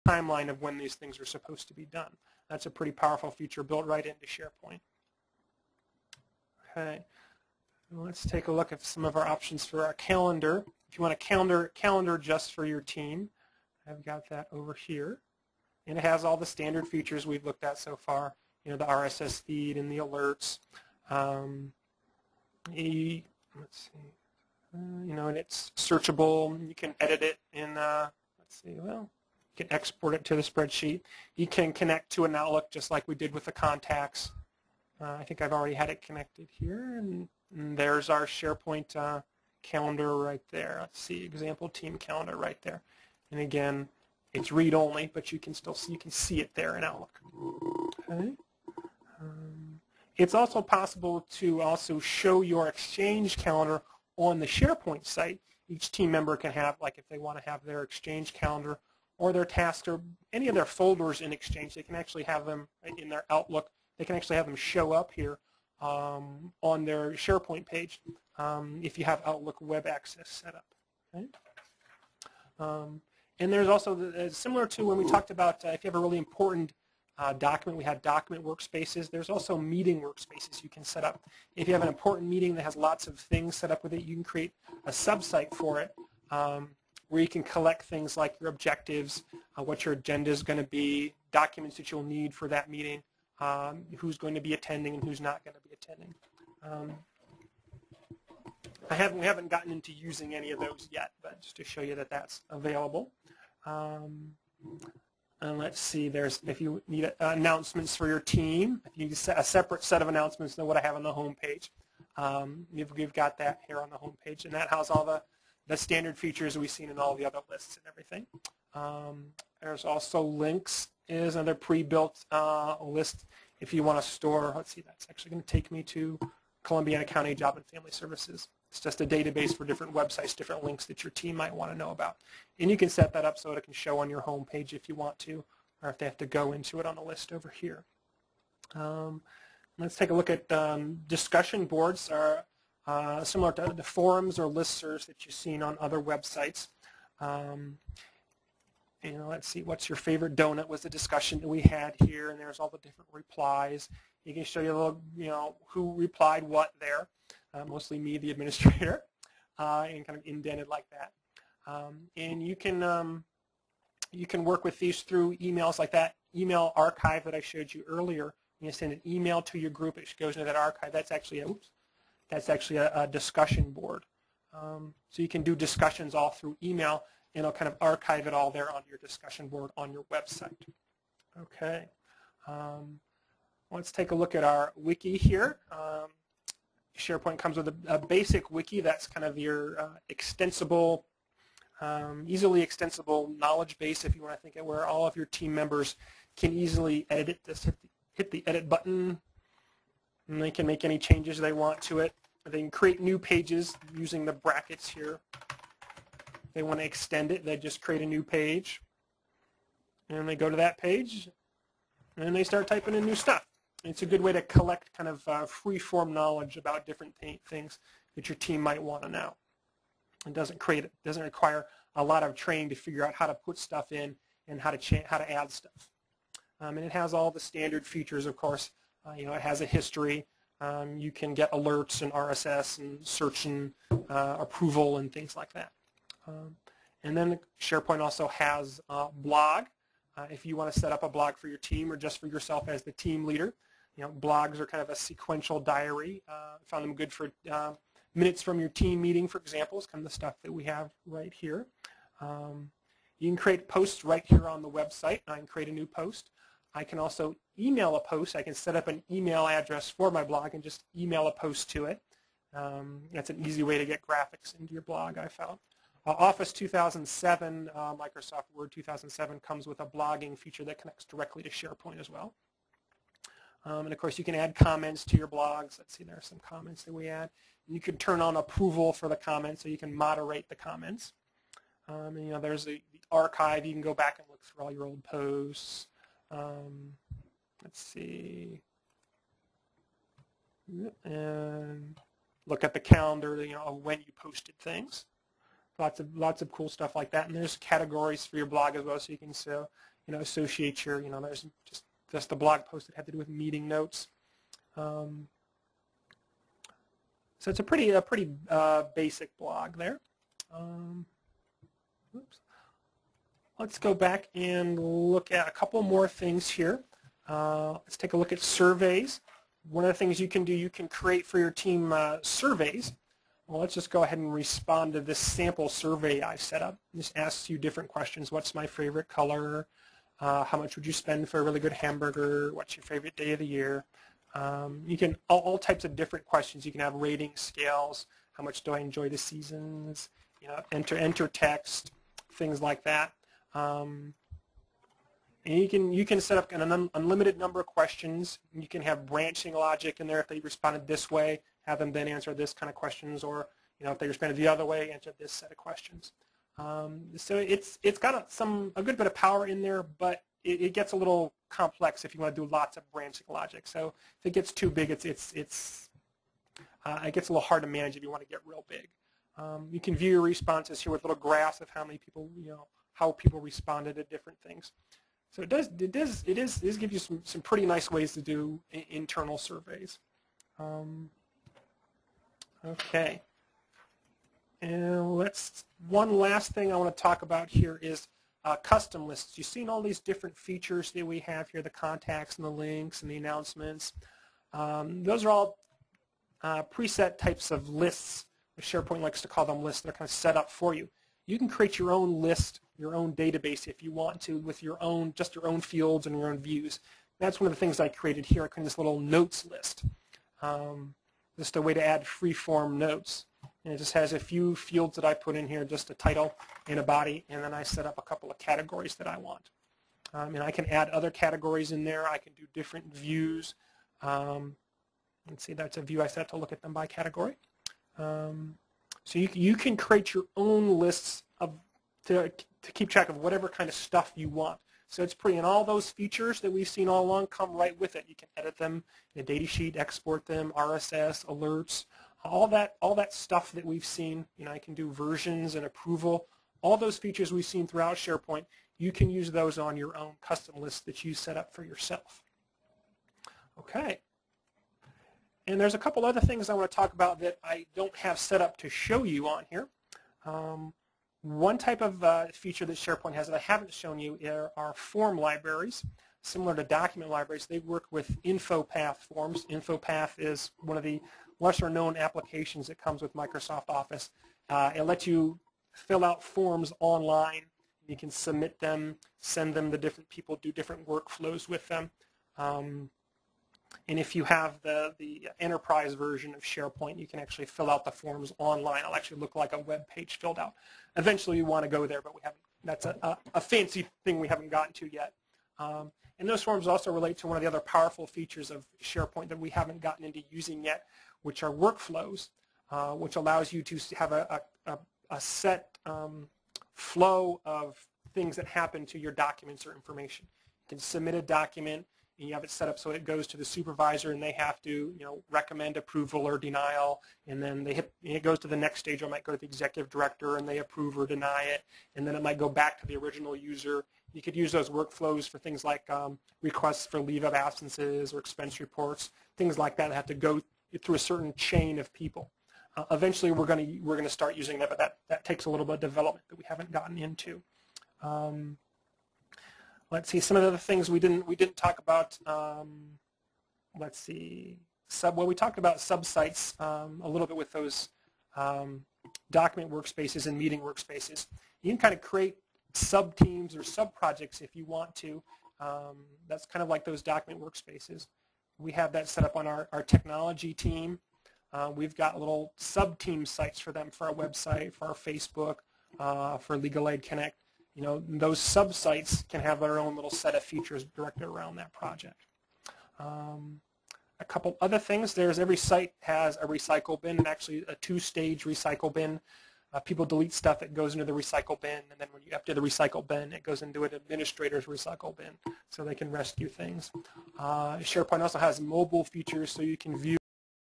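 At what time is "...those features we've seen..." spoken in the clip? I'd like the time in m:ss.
7:26.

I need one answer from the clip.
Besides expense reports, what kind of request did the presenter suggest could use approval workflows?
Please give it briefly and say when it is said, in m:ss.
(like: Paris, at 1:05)
leave of absences, at 8:47.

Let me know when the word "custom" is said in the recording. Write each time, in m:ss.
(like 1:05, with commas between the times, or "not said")
6:28, 7:30.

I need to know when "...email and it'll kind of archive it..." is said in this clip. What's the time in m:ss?
2:56.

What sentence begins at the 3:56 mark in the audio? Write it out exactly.
Um, and then SharePoint also has blog.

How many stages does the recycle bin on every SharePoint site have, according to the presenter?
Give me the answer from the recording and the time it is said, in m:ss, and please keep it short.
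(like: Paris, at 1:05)
2, at 9:37.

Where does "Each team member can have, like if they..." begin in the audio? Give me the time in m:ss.
0:55.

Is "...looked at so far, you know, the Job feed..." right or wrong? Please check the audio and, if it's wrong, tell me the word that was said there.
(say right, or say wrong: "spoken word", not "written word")
wrong: "RSS", not "Job".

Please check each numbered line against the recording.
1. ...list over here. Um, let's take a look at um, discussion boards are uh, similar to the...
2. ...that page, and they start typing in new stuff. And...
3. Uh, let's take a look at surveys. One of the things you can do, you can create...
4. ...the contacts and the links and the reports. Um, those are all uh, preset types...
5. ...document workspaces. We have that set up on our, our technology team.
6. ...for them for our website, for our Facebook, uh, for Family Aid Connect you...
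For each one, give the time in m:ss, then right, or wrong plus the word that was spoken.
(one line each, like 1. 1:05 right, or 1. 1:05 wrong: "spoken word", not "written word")
1. 2:17 right
2. 3:30 right
3. 5:17 right
4. 6:31 wrong: "announcements", not "reports"
5. 9:17 right
6. 9:23 wrong: "Legal", not "Family".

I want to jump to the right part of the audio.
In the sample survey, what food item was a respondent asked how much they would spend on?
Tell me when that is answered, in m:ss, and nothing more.
5:31.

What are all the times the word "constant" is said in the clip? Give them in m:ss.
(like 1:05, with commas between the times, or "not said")
not said.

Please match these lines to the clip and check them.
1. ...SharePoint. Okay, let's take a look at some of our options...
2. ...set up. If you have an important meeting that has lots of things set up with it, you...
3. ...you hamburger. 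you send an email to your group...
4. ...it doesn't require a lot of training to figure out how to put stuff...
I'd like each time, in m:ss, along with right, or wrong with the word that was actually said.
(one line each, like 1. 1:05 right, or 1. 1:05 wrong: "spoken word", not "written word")
1. 0:04 right
2. 1:20 right
3. 2:47 wrong: "earlier", not "hamburger"
4. 3:40 right.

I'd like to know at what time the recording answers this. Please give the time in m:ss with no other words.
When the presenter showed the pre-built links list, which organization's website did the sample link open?
2:06.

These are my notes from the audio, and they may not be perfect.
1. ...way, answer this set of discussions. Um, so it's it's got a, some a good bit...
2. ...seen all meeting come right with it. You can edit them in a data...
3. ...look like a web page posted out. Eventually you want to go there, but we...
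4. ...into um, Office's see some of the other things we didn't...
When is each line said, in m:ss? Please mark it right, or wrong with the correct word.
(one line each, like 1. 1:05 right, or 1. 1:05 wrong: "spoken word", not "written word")
1. 5:54 wrong: "questions", not "discussions"
2. 7:16 wrong: "along", not "meeting"
3. 8:09 wrong: "filled", not "posted"
4. 8:56 wrong: "Let", not "Office".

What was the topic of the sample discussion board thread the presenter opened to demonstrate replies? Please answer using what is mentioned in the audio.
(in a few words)
favorite donut.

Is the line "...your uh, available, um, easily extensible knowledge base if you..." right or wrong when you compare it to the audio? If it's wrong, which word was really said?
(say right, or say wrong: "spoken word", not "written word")
wrong: "extensible", not "available".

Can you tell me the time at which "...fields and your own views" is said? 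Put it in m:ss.
6:45.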